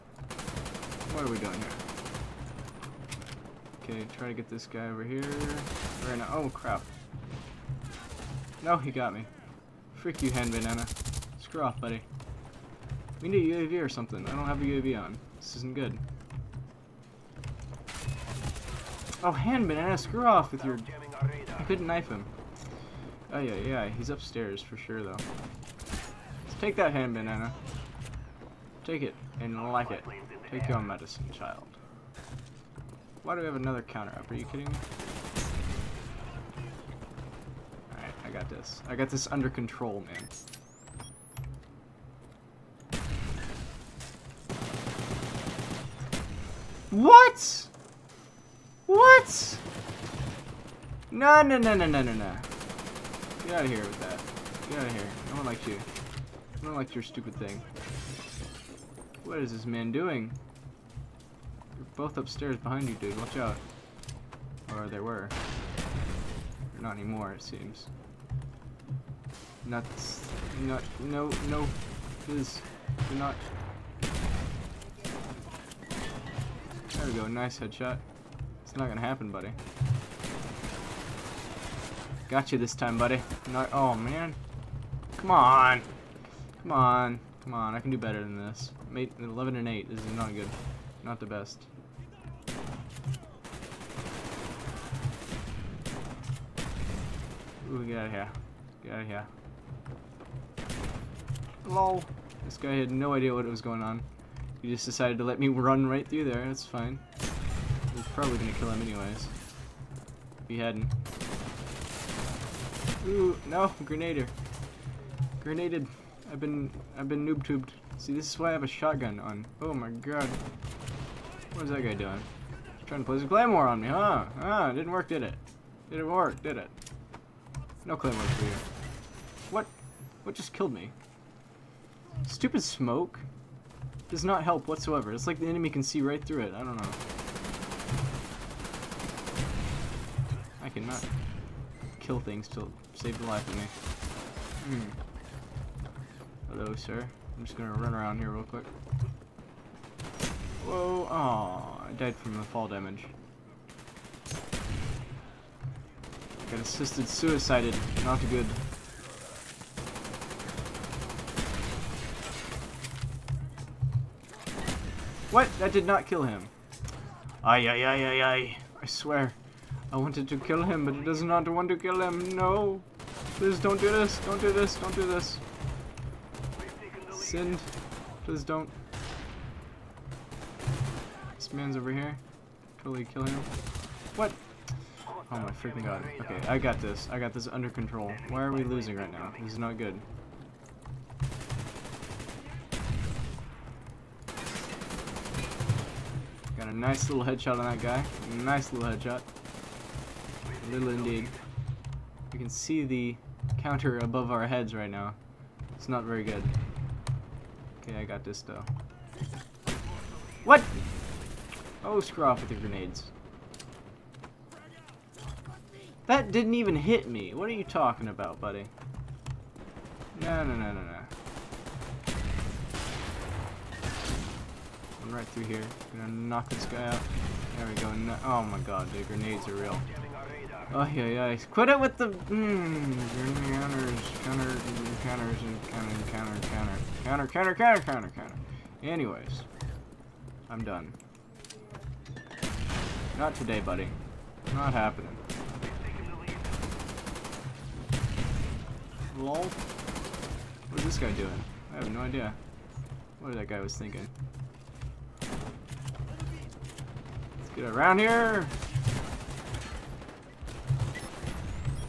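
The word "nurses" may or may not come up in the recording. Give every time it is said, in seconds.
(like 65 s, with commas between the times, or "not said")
not said.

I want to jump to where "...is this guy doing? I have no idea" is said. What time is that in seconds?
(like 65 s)
250 s.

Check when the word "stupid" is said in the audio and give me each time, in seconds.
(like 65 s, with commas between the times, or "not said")
57 s, 132 s.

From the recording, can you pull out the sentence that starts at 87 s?
Come on, I can do better than this.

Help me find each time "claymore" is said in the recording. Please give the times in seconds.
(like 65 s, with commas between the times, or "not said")
123 s, 127 s.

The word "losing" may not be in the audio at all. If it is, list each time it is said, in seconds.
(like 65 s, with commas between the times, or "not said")
188 s.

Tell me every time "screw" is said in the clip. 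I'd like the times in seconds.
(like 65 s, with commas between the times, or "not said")
11 s, 19 s, 211 s.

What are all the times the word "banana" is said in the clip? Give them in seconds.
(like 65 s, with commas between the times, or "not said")
10 s, 19 s, 27 s.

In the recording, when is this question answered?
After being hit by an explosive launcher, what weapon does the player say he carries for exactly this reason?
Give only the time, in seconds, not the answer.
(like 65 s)
118 s.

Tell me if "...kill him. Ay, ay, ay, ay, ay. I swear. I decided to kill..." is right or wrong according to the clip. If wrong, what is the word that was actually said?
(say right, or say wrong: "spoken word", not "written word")
wrong: "wanted", not "decided".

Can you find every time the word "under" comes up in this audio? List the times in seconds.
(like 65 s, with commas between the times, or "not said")
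39 s, 187 s.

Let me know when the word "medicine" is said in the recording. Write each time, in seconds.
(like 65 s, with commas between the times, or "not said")
30 s.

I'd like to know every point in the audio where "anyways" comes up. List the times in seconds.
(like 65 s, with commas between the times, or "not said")
108 s, 238 s.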